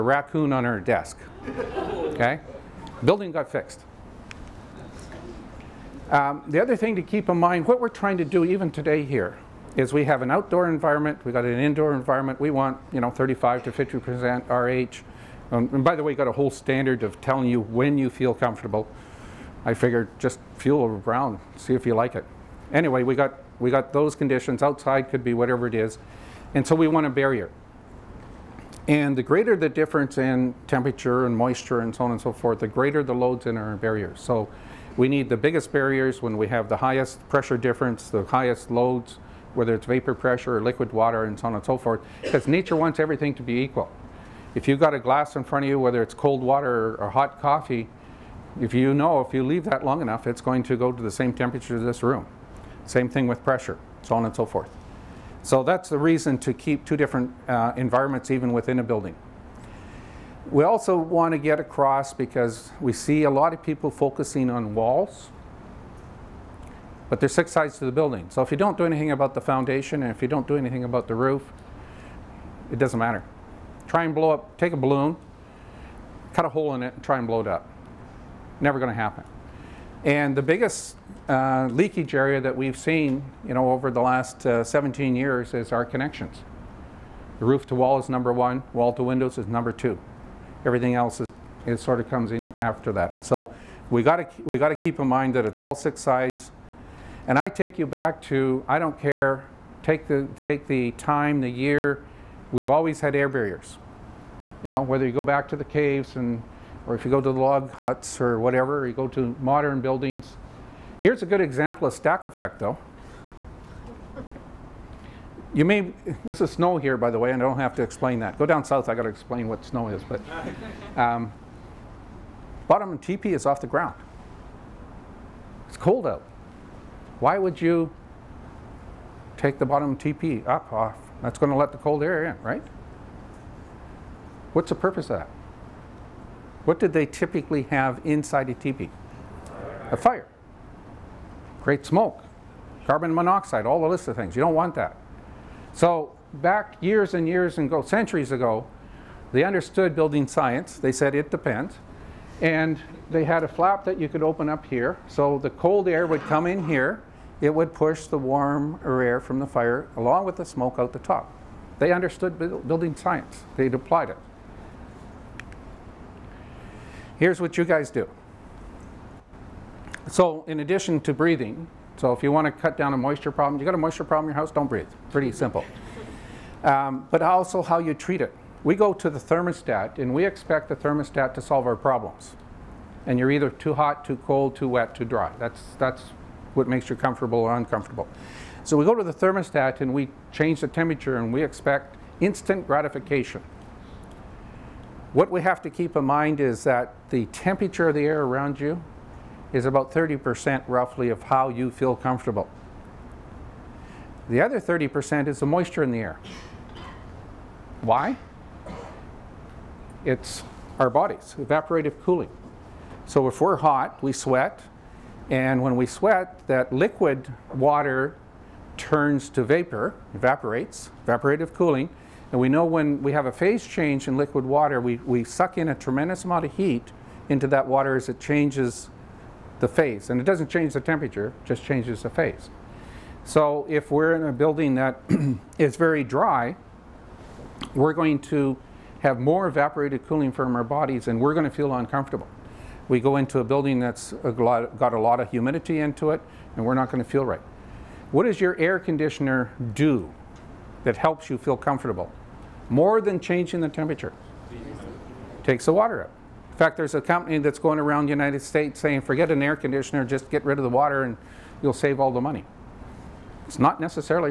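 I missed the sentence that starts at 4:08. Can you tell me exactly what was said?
What does your air conditioner do that helps you feel comfortable?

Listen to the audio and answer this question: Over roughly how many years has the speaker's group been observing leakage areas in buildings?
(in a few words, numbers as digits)
17 years.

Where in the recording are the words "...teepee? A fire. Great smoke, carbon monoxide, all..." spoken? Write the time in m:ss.
2:18.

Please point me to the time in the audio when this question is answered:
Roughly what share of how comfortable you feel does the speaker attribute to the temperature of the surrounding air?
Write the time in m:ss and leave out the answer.
3:19.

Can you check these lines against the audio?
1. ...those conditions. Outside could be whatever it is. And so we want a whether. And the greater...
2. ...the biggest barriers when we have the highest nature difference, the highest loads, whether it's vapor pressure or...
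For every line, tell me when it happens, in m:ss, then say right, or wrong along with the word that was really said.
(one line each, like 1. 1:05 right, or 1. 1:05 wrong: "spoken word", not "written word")
1. 0:23 wrong: "barrier", not "whether"
2. 0:35 wrong: "pressure", not "nature".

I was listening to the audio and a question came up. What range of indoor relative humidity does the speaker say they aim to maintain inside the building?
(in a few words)
35 to 50%.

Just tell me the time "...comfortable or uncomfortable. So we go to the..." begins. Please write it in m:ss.
3:06.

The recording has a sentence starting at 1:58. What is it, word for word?
Go down south, I gotta explain what snow is, but.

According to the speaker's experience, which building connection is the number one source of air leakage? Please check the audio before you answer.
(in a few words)
Roof to wall.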